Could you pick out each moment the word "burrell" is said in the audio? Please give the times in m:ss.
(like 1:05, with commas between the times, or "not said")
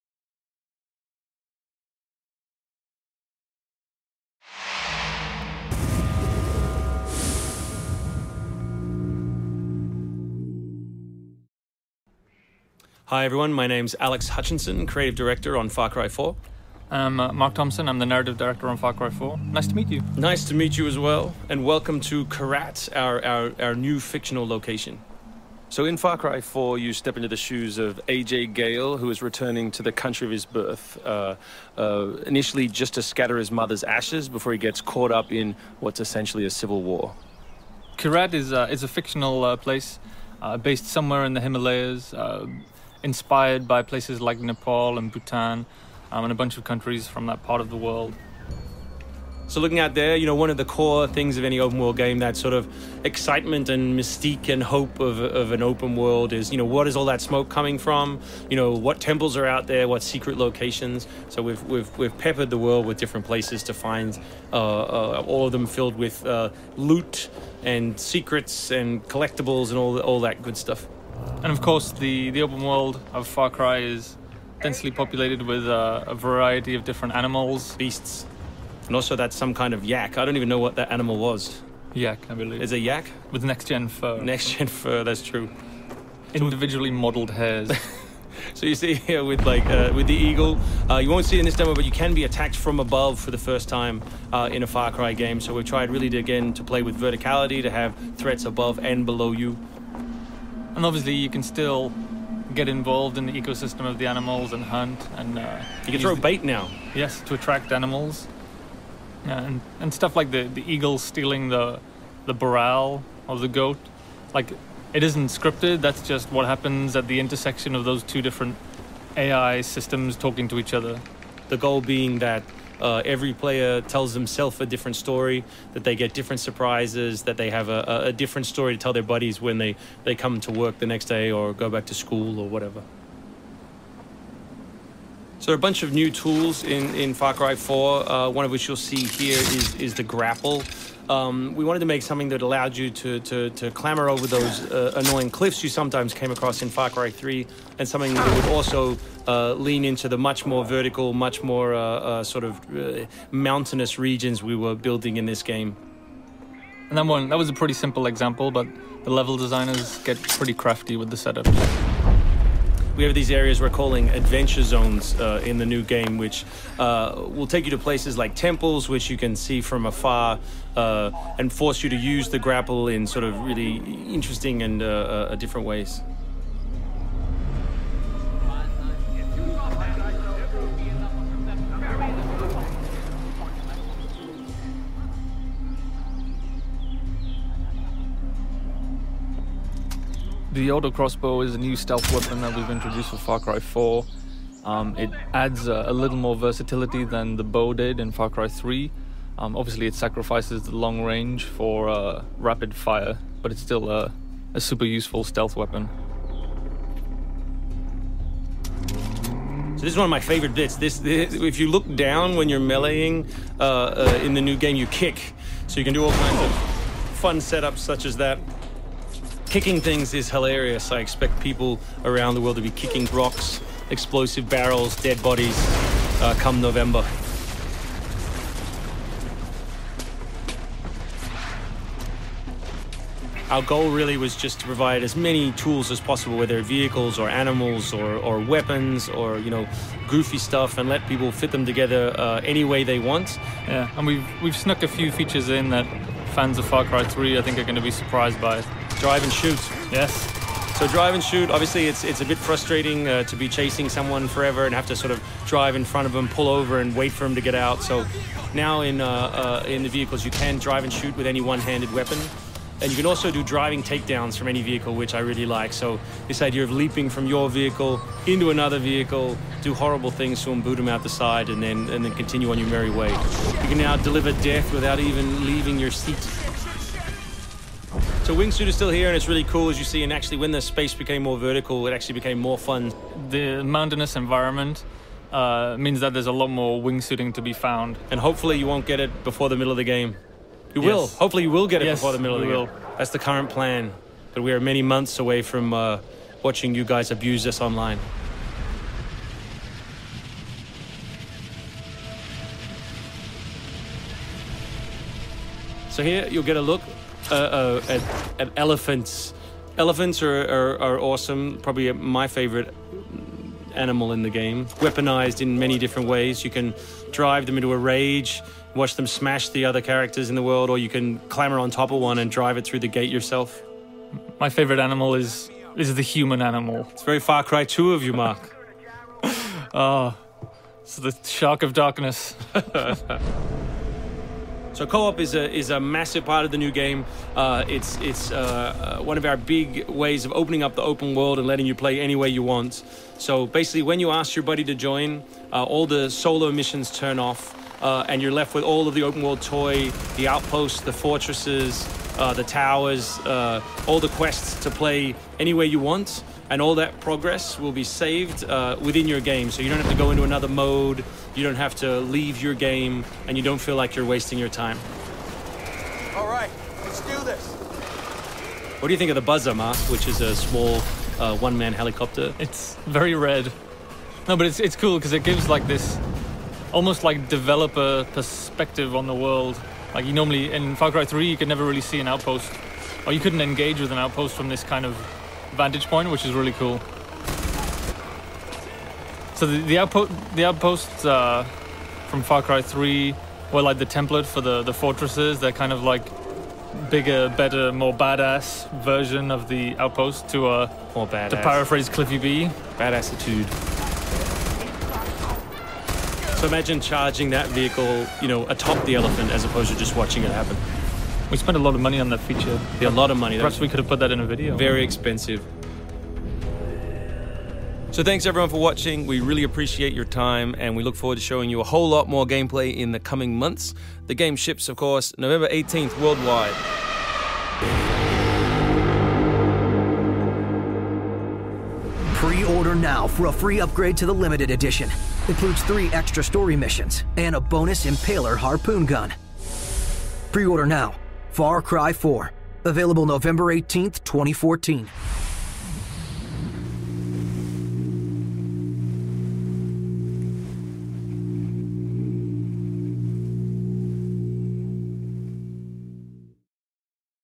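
1:52.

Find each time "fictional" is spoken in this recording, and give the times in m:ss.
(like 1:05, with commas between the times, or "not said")
0:23, 0:38.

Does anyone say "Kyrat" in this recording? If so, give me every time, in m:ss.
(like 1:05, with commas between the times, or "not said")
0:22, 0:37.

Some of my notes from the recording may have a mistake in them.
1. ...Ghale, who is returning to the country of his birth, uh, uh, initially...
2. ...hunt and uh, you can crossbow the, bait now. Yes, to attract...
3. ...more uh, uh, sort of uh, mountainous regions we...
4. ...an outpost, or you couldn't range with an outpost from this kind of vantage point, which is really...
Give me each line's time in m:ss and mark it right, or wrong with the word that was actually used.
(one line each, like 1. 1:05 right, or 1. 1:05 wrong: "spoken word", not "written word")
1. 0:28 right
2. 1:44 wrong: "throw", not "crossbow"
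3. 2:31 right
4. 6:22 wrong: "engage", not "range".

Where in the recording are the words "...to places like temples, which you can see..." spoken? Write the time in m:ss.
2:47.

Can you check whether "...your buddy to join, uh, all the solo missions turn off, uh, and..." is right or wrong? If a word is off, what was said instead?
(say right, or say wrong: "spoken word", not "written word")
right.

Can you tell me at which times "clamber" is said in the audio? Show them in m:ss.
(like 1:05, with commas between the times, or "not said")
2:23, 5:21.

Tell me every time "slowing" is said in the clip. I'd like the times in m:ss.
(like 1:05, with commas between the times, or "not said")
not said.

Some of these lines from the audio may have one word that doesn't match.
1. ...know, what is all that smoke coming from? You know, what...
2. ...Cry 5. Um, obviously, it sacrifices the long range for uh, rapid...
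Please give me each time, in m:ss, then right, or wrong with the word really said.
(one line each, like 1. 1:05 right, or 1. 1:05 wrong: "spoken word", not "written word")
1. 0:56 right
2. 3:18 wrong: "3", not "5".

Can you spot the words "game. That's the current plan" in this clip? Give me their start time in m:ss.
4:52.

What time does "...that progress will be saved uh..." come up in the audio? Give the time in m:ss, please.
5:56.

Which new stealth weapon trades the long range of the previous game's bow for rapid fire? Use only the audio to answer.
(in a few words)
auto crossbow.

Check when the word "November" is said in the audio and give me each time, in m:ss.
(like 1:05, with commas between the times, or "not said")
3:46, 7:05, 7:23.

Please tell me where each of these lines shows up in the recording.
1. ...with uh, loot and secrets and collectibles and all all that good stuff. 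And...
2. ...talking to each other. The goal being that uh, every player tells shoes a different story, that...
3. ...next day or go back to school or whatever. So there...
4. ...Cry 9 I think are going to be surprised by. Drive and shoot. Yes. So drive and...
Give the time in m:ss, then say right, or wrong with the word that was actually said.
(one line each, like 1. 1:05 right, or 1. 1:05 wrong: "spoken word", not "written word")
1. 1:05 right
2. 2:00 wrong: "themselves", not "shoes"
3. 2:10 right
4. 4:06 wrong: "3", not "9".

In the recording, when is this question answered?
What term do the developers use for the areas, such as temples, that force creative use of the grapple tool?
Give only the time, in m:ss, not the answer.
2:44.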